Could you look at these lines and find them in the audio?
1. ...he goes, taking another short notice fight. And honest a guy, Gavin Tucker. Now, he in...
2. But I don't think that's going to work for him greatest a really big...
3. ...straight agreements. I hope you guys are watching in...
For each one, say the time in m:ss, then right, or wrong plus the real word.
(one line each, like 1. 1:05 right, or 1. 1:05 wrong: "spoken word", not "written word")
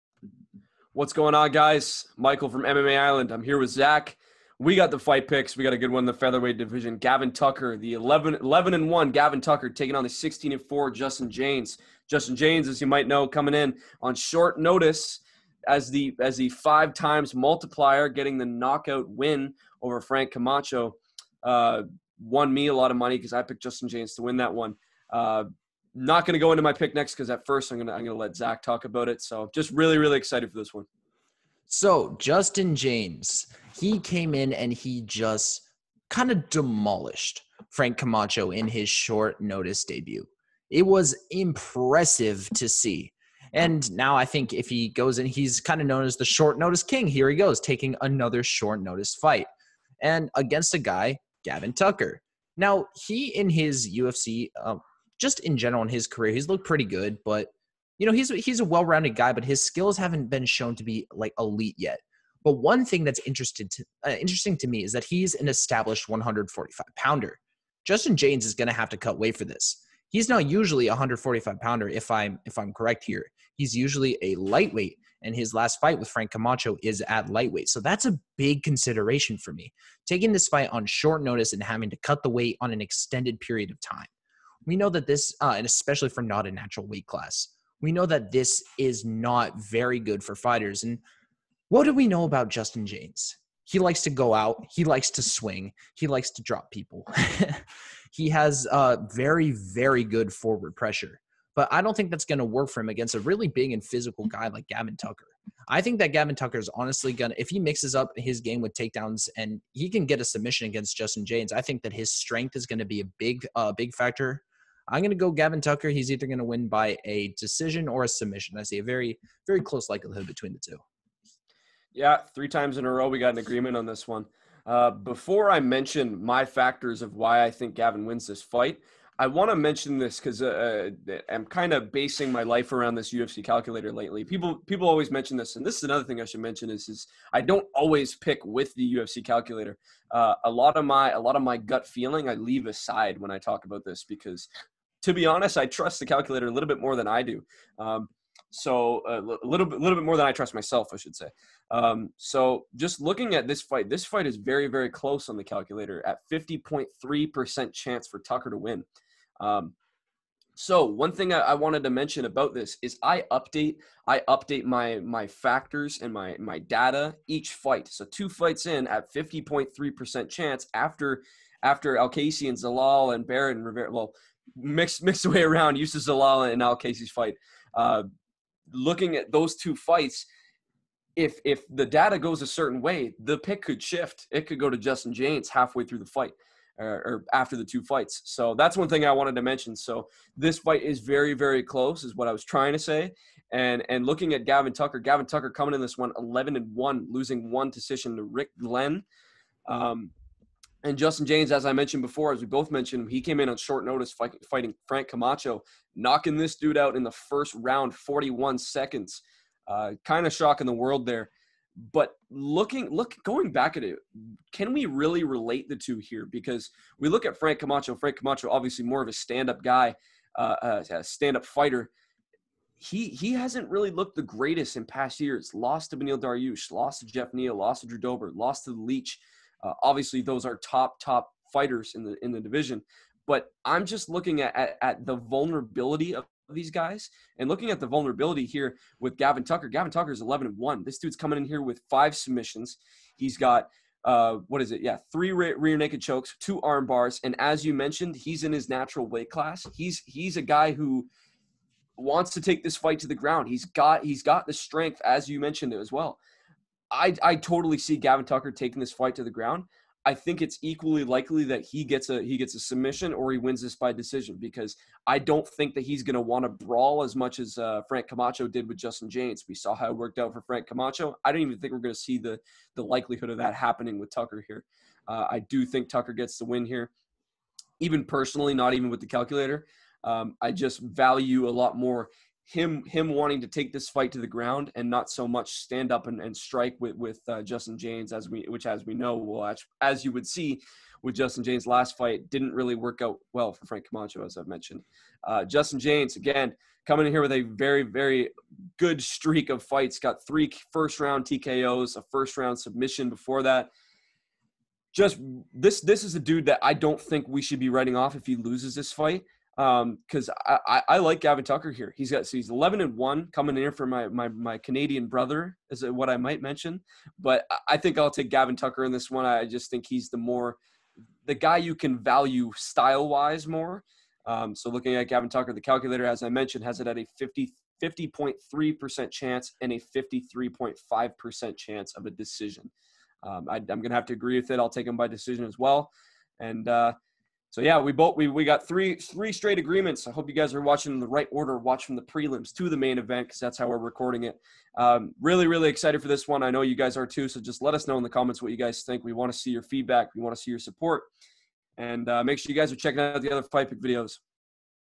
1. 0:47 wrong: "against", not "honest"
2. 1:41 wrong: "against", not "greatest"
3. 5:39 right.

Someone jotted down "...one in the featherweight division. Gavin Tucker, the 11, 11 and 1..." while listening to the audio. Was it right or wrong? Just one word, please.
right.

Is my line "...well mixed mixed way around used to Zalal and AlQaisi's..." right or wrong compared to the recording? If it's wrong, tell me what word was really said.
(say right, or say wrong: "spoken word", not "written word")
right.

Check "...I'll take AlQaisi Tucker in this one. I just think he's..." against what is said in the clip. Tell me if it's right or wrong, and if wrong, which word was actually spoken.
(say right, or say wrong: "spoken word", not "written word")
wrong: "Gavin", not "AlQaisi".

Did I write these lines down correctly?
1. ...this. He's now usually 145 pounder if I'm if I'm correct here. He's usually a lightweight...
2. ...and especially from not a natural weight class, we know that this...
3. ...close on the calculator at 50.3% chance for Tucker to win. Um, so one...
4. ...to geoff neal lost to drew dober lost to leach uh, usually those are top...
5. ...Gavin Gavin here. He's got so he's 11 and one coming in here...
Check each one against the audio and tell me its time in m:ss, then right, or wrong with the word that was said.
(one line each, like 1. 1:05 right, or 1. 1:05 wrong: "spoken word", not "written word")
1. 1:09 right
2. 1:25 right
3. 2:34 right
4. 3:47 wrong: "obviously", not "usually"
5. 5:11 wrong: "Tucker", not "Gavin".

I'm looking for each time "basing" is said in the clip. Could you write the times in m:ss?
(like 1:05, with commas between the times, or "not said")
2:11.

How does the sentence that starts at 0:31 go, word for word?
So Justin Jaynes, he came in and he just kind of demolished Frank Camacho in his short notice debut.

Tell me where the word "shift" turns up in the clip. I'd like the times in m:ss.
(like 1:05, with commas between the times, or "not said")
3:03.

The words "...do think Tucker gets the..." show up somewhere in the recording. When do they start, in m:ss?
4:35.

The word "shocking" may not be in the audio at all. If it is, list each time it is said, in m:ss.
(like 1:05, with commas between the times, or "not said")
3:30.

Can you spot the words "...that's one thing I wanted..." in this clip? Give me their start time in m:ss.
3:08.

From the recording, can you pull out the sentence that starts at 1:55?
He's either going to win by a decision or a submission.